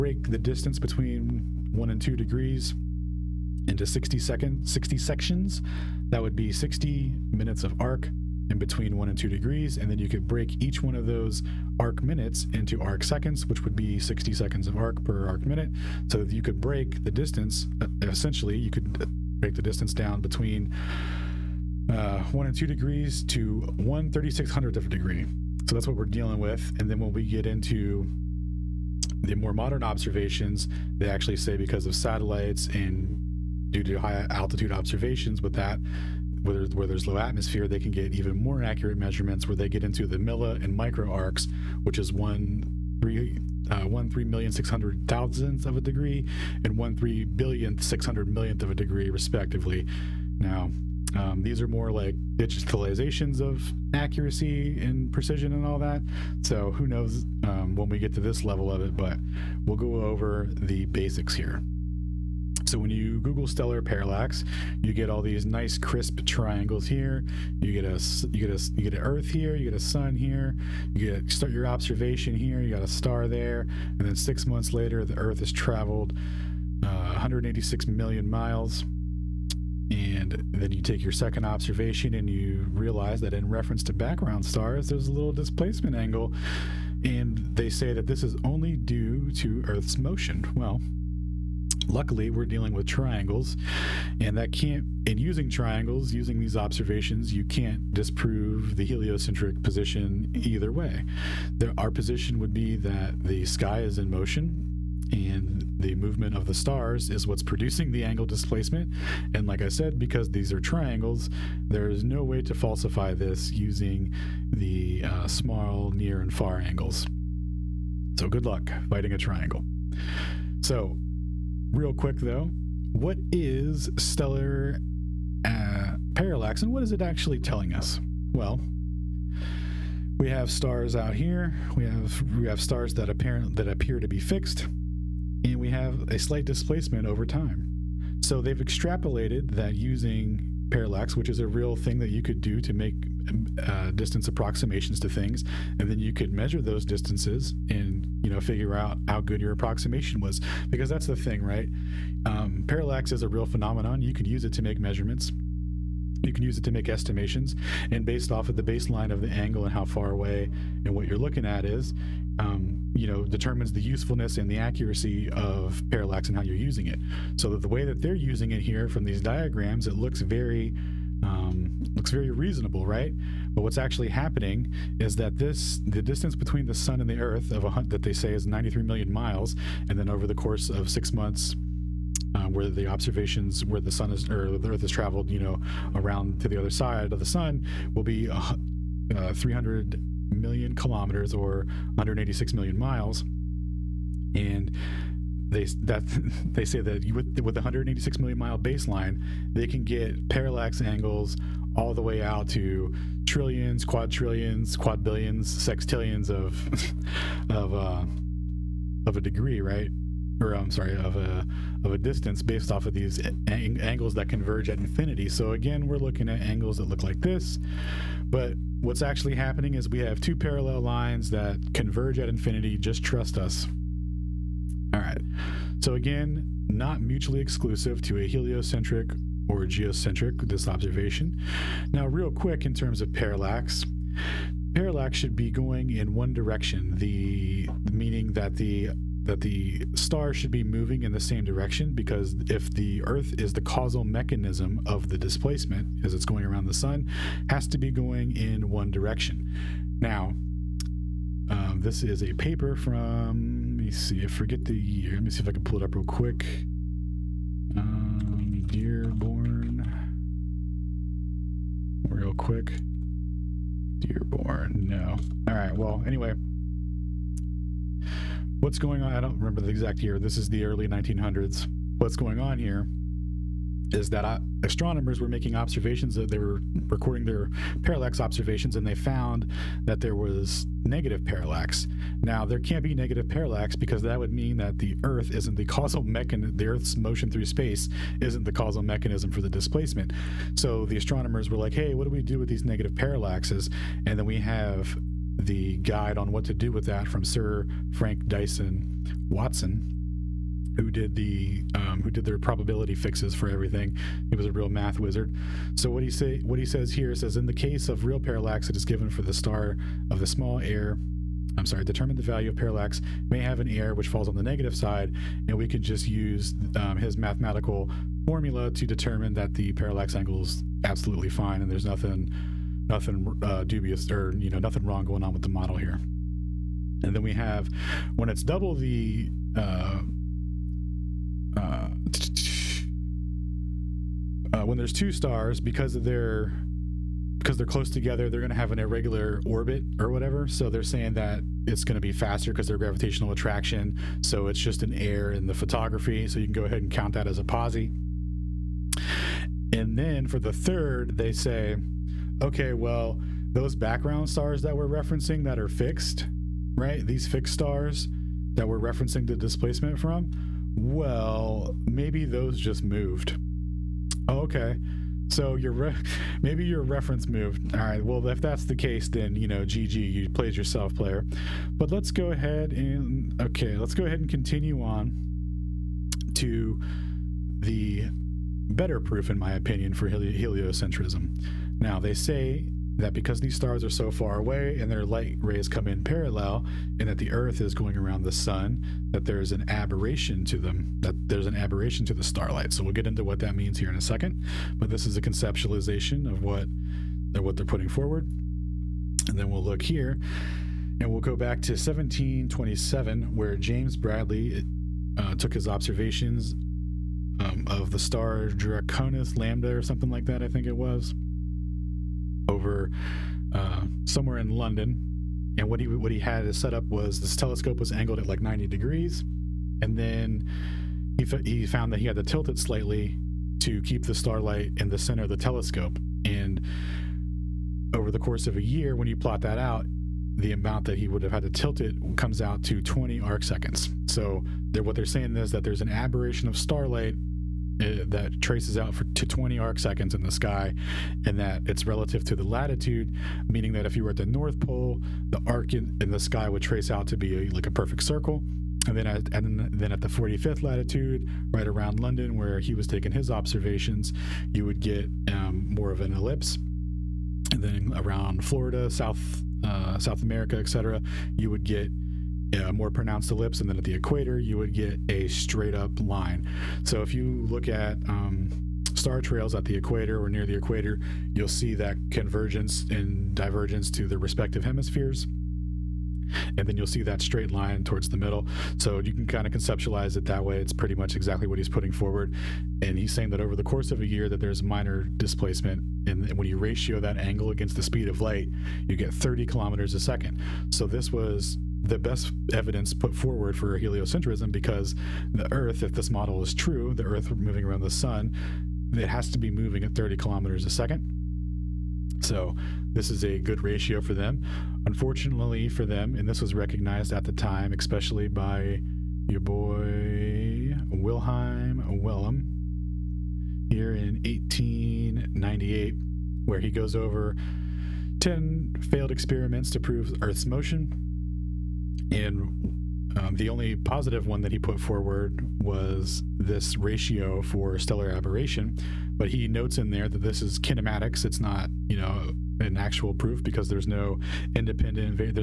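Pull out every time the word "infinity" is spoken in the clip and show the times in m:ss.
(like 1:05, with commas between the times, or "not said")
3:34, 3:42.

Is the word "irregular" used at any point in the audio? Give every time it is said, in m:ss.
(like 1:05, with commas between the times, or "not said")
5:38.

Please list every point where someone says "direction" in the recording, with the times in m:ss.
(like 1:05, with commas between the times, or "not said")
3:56, 4:01, 4:08.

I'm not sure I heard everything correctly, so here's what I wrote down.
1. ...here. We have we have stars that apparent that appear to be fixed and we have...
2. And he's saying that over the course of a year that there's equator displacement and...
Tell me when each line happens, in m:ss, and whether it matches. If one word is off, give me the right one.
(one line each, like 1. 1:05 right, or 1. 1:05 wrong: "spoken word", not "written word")
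1. 2:11 right
2. 8:02 wrong: "minor", not "equator".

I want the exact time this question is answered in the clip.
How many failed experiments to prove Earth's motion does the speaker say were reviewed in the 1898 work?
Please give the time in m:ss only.
8:38.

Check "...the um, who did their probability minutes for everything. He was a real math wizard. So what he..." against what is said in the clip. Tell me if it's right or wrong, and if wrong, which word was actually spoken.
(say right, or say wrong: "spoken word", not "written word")
wrong: "fixes", not "minutes".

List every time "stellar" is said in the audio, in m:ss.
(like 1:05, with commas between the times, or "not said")
1:03, 2:03, 8:47.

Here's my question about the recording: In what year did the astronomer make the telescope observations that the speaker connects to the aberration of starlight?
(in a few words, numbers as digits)
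1727.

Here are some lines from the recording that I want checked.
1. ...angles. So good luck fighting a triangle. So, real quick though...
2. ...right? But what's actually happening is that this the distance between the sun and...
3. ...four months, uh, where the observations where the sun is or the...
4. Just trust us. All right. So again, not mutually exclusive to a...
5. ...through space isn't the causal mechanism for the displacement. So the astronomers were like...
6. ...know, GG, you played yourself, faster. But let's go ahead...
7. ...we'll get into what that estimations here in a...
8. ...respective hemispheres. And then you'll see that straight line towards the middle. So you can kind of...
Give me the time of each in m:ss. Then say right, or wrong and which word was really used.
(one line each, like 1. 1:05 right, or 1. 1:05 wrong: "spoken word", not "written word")
1. 1:56 right
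2. 2:52 right
3. 3:00 wrong: "six", not "four"
4. 3:42 right
5. 4:47 right
6. 6:09 wrong: "player", not "faster"
7. 6:32 wrong: "means", not "estimations"
8. 7:54 right.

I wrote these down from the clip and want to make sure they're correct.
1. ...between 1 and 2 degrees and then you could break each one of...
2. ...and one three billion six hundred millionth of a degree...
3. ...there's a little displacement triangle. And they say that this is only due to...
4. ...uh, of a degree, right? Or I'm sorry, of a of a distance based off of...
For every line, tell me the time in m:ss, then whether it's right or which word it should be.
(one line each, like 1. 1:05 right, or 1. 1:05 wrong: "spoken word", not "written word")
1. 0:08 right
2. 0:46 right
3. 1:24 wrong: "angle", not "triangle"
4. 3:27 right.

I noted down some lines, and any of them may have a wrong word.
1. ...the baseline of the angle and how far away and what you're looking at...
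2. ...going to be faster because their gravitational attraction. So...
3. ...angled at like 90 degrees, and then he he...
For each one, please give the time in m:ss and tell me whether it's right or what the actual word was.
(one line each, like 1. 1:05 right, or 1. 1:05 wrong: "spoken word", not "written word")
1. 2:38 right
2. 5:41 right
3. 6:57 right.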